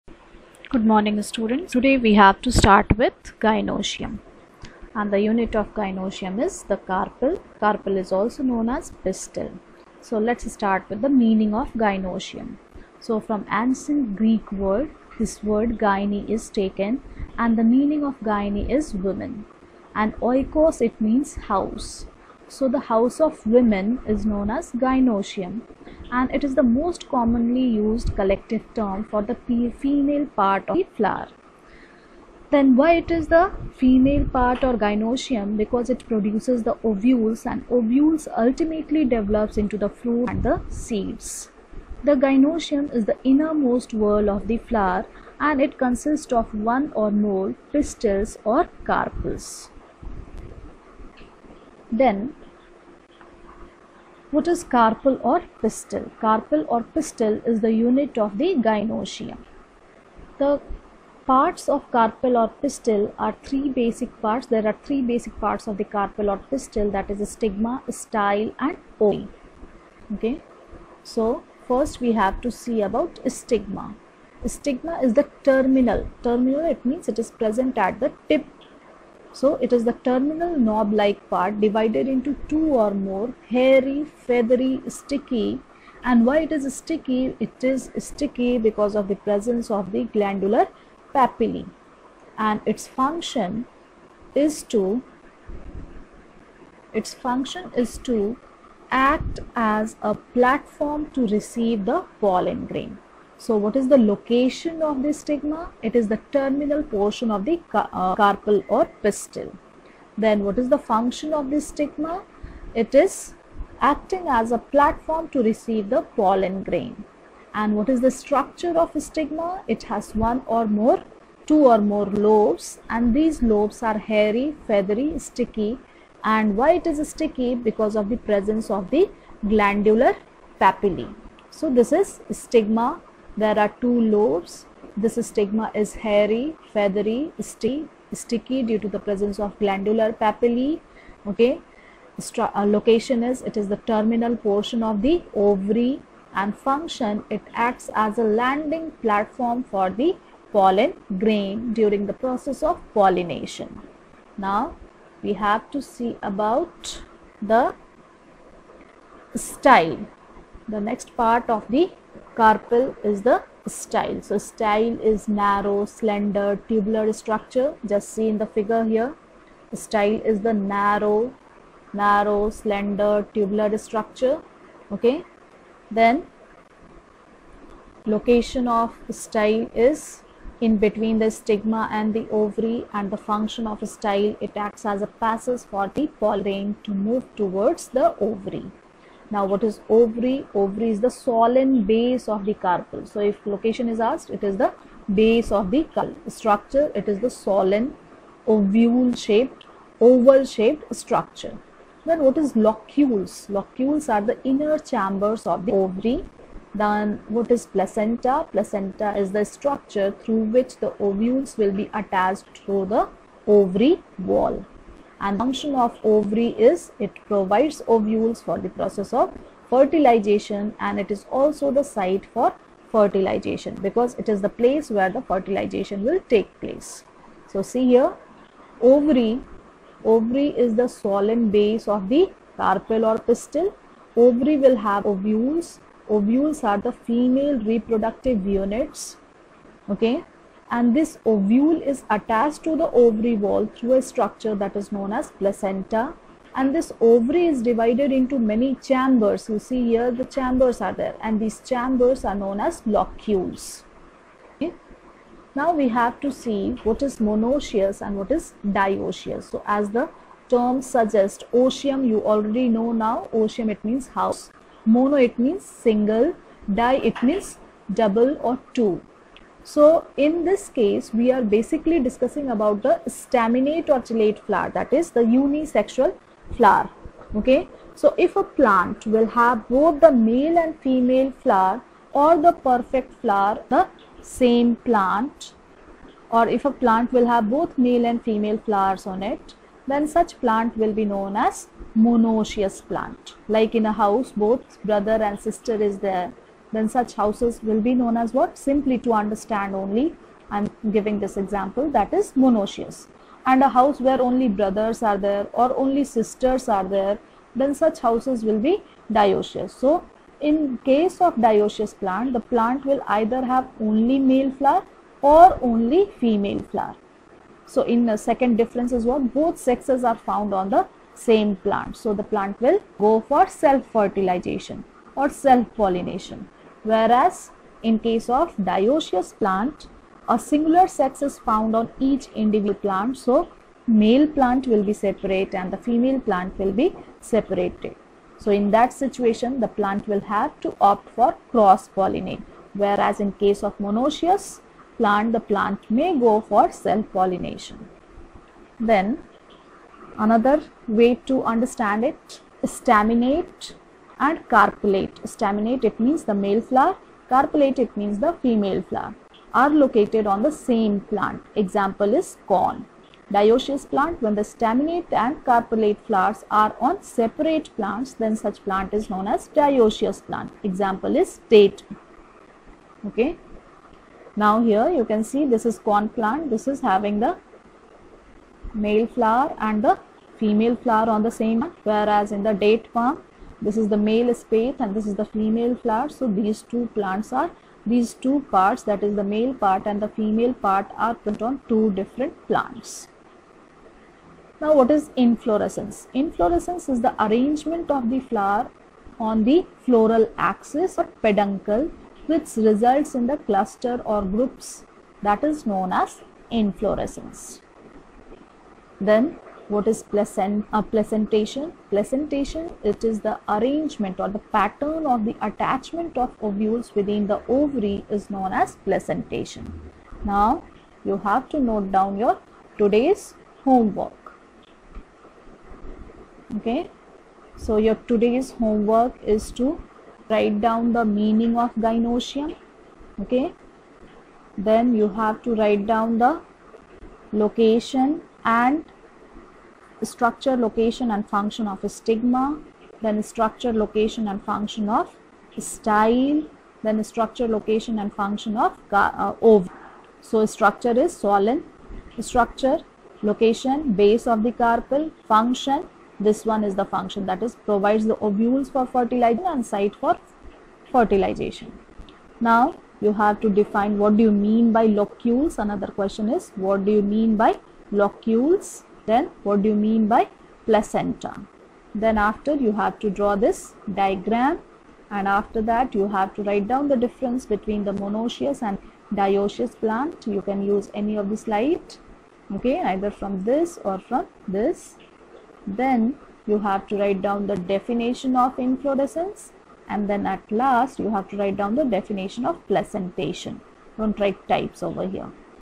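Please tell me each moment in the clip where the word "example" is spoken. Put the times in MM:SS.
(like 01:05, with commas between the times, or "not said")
05:01, 06:01, 06:10.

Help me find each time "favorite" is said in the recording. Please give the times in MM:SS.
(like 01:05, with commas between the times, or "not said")
not said.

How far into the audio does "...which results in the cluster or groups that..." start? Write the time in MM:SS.
06:42.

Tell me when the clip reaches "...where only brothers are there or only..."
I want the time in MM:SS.
05:04.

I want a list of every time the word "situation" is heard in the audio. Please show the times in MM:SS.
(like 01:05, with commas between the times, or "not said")
05:38.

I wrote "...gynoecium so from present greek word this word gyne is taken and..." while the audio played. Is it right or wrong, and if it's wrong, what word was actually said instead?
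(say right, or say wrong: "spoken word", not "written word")
wrong: "ancient", not "present".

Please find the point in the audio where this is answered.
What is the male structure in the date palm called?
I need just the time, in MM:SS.
06:23.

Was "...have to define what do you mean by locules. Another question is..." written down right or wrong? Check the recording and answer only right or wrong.
right.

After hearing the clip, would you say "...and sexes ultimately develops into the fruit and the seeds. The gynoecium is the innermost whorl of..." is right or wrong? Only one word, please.
wrong.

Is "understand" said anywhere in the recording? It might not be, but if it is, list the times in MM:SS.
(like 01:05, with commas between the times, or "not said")
04:59, 05:51.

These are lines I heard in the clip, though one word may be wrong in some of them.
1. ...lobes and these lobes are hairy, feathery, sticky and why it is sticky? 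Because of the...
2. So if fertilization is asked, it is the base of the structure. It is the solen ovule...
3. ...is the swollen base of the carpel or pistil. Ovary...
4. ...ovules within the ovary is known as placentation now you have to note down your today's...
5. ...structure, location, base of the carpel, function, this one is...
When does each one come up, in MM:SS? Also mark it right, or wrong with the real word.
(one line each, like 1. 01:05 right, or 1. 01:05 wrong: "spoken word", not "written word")
1. 02:02 right
2. 03:13 wrong: "location", not "fertilization"
3. 03:50 right
4. 06:56 right
5. 07:32 right.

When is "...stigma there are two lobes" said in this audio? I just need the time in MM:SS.
02:12.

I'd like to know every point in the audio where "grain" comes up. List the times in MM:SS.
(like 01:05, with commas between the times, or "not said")
01:42, 01:56, 02:31.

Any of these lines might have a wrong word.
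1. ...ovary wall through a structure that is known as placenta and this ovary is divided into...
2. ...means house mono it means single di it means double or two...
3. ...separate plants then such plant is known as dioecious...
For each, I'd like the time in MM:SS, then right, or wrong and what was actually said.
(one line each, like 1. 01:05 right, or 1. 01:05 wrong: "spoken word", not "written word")
1. 04:03 right
2. 04:23 right
3. 06:07 right.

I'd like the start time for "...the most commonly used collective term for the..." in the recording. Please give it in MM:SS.
00:26.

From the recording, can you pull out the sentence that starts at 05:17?
So, in the second difference is what?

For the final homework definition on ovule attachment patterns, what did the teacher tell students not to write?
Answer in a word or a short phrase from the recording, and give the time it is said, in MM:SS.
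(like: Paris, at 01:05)
types, at 08:13.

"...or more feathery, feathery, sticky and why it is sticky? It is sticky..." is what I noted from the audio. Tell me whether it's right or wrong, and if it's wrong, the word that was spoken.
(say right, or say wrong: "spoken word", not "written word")
wrong: "hairy", not "feathery".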